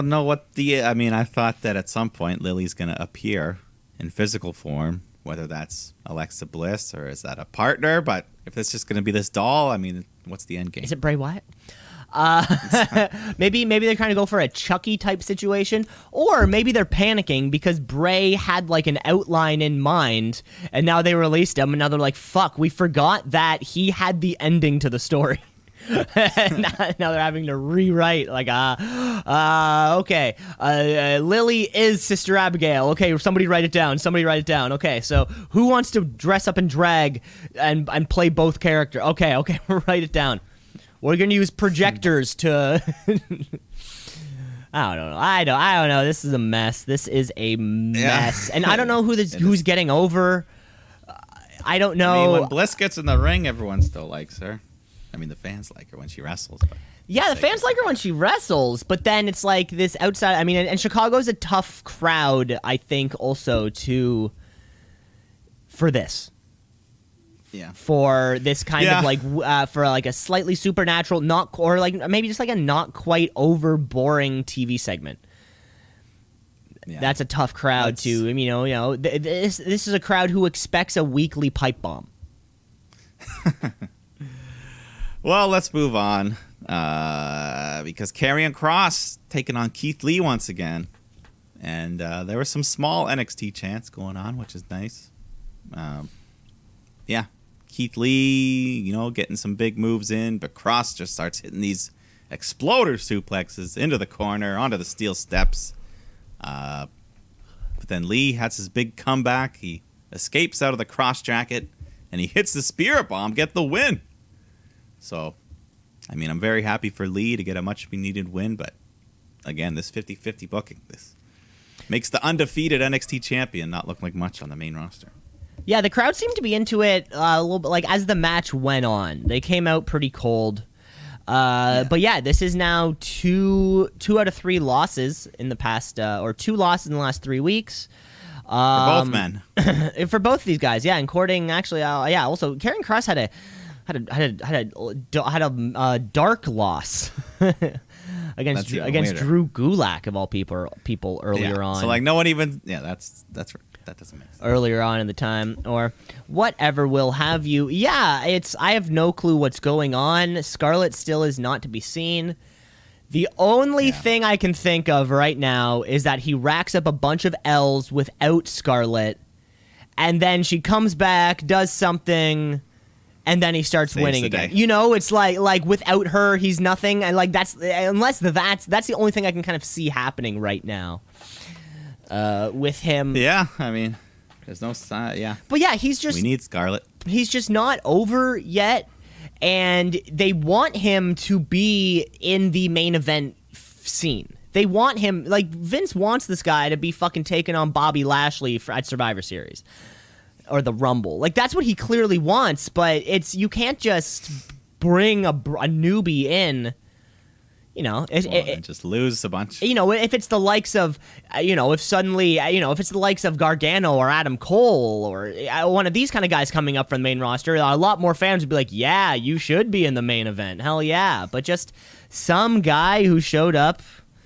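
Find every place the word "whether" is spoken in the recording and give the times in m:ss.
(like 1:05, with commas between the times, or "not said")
0:05.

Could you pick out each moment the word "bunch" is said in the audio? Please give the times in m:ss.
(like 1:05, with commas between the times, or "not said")
2:46, 3:29.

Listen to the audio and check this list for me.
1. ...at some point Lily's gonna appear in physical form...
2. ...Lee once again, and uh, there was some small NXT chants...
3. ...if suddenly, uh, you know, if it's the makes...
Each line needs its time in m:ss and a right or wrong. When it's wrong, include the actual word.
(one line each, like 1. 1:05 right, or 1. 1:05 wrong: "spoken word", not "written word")
1. 0:01 right
2. 1:30 right
3. 3:31 wrong: "likes", not "makes".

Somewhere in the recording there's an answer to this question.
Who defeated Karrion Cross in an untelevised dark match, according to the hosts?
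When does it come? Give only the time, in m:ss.
2:29.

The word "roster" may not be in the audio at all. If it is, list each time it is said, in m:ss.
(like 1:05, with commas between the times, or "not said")
2:04, 3:37.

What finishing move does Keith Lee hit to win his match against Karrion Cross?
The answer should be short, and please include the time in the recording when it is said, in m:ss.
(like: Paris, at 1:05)
Spear bomb, at 1:52.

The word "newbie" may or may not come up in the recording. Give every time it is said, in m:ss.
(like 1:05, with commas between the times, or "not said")
3:25.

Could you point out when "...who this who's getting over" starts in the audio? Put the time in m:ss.
0:49.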